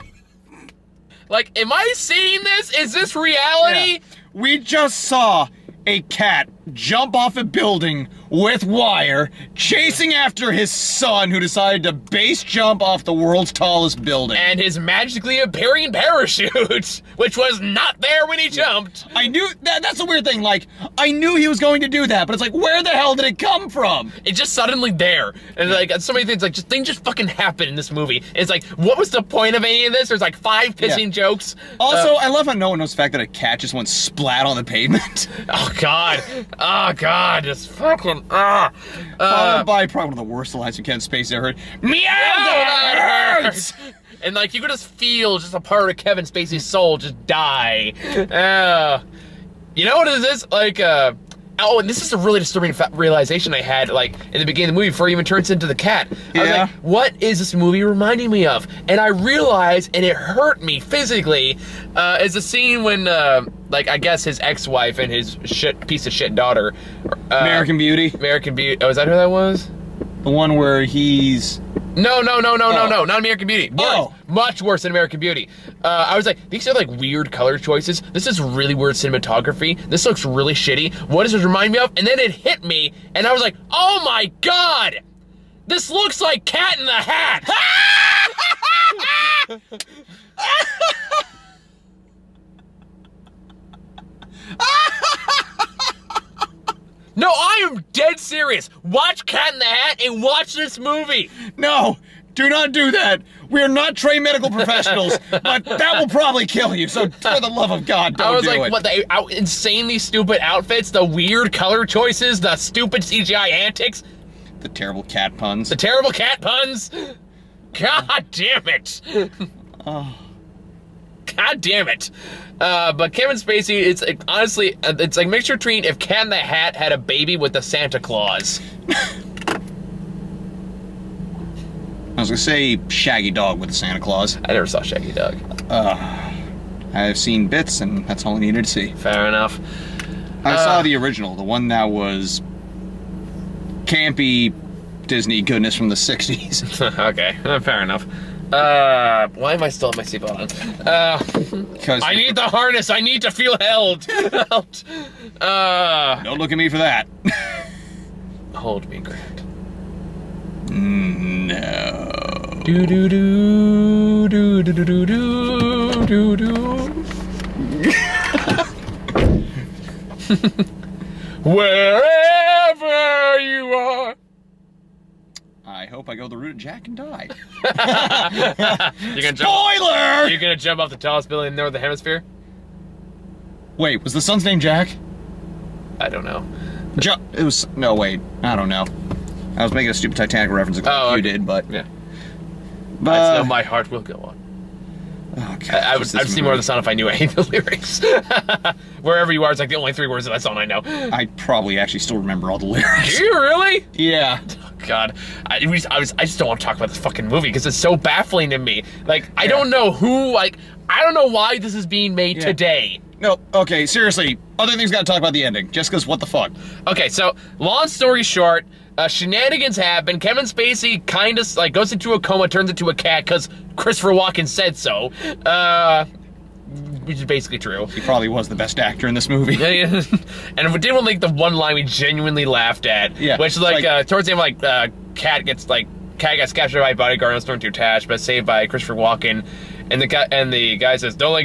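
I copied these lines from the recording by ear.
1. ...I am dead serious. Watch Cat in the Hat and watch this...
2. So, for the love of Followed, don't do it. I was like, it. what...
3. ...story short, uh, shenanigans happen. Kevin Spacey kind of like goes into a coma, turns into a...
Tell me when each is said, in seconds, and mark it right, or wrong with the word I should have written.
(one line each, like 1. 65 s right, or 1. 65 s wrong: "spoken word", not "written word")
1. 97 s right
2. 106 s wrong: "God", not "Followed"
3. 217 s right.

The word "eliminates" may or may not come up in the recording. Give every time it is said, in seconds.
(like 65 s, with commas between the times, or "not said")
not said.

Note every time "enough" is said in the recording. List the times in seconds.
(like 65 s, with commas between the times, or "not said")
139 s, 147 s.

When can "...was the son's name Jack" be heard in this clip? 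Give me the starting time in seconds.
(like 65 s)
184 s.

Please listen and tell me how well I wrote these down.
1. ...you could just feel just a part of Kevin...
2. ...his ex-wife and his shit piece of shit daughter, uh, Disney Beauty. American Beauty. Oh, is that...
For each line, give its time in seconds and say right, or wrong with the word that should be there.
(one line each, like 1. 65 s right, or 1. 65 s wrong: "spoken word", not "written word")
1. 44 s right
2. 64 s wrong: "American", not "Disney".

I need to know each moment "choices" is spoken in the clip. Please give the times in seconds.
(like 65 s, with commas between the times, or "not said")
77 s, 111 s.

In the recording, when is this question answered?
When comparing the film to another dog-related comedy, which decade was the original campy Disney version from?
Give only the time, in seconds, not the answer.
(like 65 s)
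145 s.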